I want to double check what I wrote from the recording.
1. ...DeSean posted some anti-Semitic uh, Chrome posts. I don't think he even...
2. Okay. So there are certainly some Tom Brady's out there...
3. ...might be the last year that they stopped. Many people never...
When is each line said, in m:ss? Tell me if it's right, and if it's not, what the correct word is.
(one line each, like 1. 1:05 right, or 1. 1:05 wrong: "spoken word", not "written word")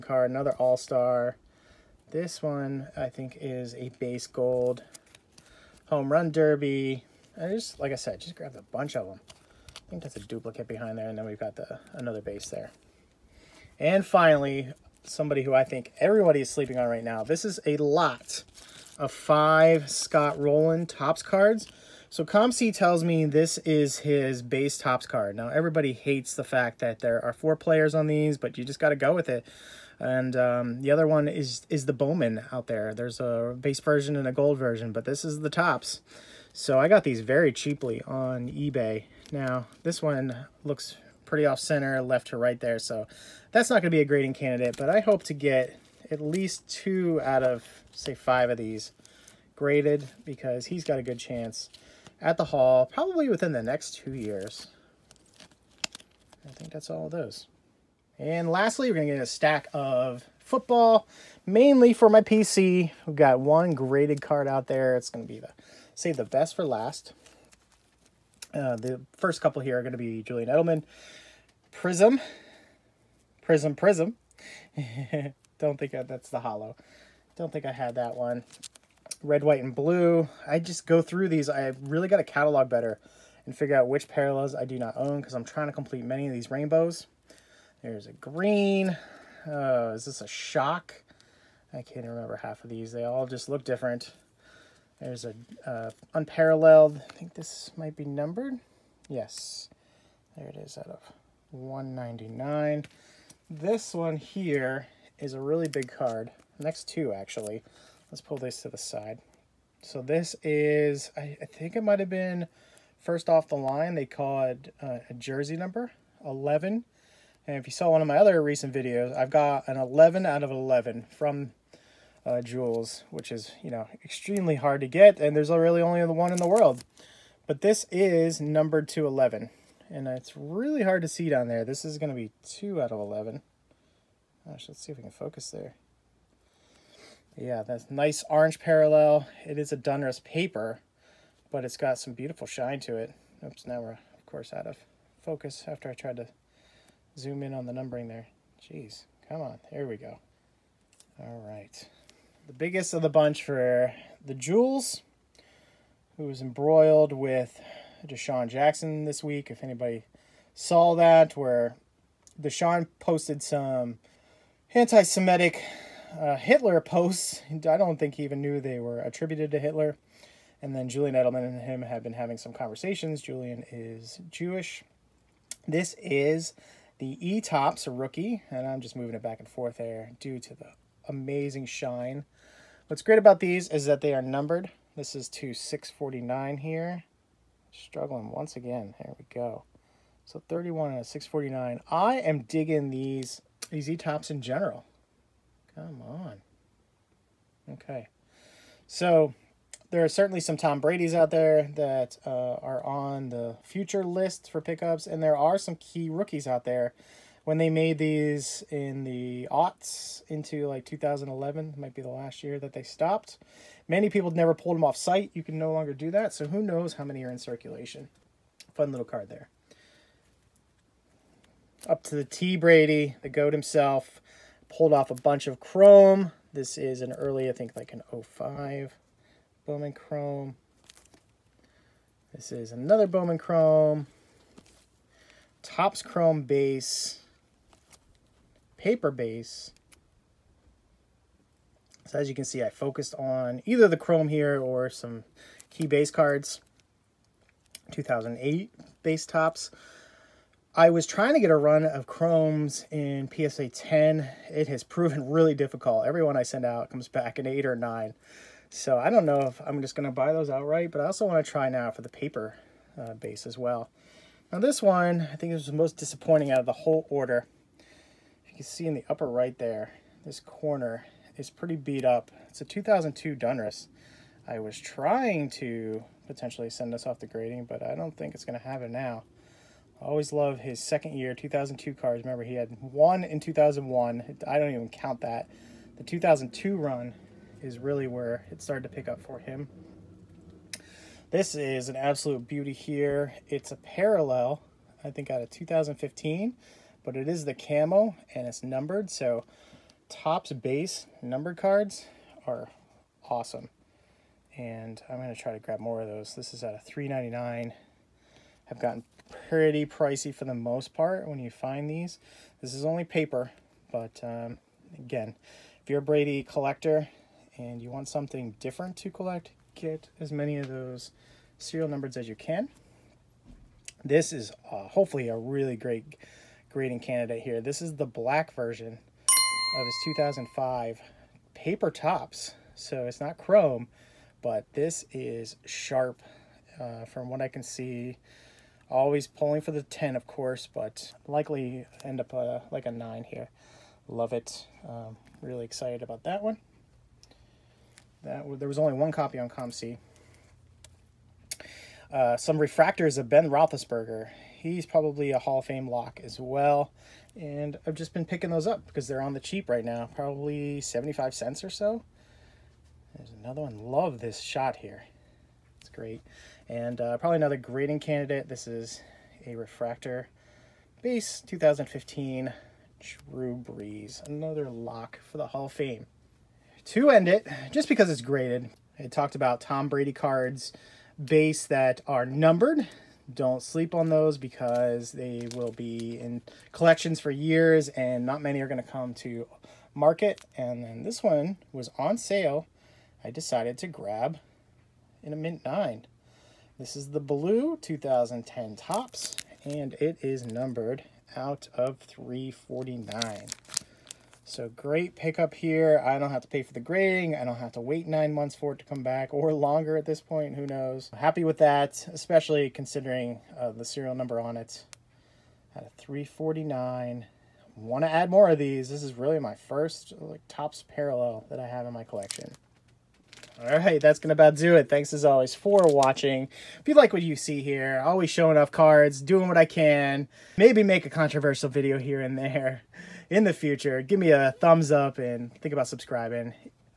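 1. 2:42 wrong: "Hitler", not "Chrome"
2. 3:17 right
3. 3:31 right.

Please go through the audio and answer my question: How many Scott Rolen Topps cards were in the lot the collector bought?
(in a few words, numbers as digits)
5.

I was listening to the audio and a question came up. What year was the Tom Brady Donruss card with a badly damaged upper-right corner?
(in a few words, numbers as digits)
2002.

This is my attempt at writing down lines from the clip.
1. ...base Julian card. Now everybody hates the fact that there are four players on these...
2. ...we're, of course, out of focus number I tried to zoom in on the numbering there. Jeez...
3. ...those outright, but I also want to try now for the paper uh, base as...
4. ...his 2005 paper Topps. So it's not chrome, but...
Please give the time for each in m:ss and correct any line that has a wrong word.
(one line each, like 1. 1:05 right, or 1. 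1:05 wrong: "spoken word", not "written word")
1. 0:24 wrong: "Topps", not "Julian"
2. 2:23 wrong: "after", not "number"
3. 4:20 right
4. 5:29 right.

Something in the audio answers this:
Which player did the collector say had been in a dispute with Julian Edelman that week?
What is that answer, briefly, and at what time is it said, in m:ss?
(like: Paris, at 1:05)
DeSean Jackson, at 2:38.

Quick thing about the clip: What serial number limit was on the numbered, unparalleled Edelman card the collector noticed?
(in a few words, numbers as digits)
199.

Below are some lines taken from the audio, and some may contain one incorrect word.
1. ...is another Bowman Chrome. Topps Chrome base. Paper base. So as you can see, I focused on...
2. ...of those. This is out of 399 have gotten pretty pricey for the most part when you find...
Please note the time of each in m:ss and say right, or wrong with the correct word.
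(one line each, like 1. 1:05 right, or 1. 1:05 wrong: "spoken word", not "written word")
1. 3:52 right
2. 5:06 right.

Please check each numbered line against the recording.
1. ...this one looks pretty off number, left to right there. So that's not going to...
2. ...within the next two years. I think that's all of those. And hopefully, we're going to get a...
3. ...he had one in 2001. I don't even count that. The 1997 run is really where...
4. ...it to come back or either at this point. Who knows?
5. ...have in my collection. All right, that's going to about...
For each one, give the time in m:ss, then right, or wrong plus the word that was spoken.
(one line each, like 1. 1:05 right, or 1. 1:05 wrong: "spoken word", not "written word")
1. 0:39 wrong: "center", not "number"
2. 0:53 wrong: "lastly", not "hopefully"
3. 4:42 wrong: "2002", not "1997"
4. 6:48 wrong: "longer", not "either"
5. 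7:01 right.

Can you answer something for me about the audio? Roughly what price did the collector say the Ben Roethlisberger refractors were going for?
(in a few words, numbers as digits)
75 cents.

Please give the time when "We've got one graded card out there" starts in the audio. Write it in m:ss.
1:03.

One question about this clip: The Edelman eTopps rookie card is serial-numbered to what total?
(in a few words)
649.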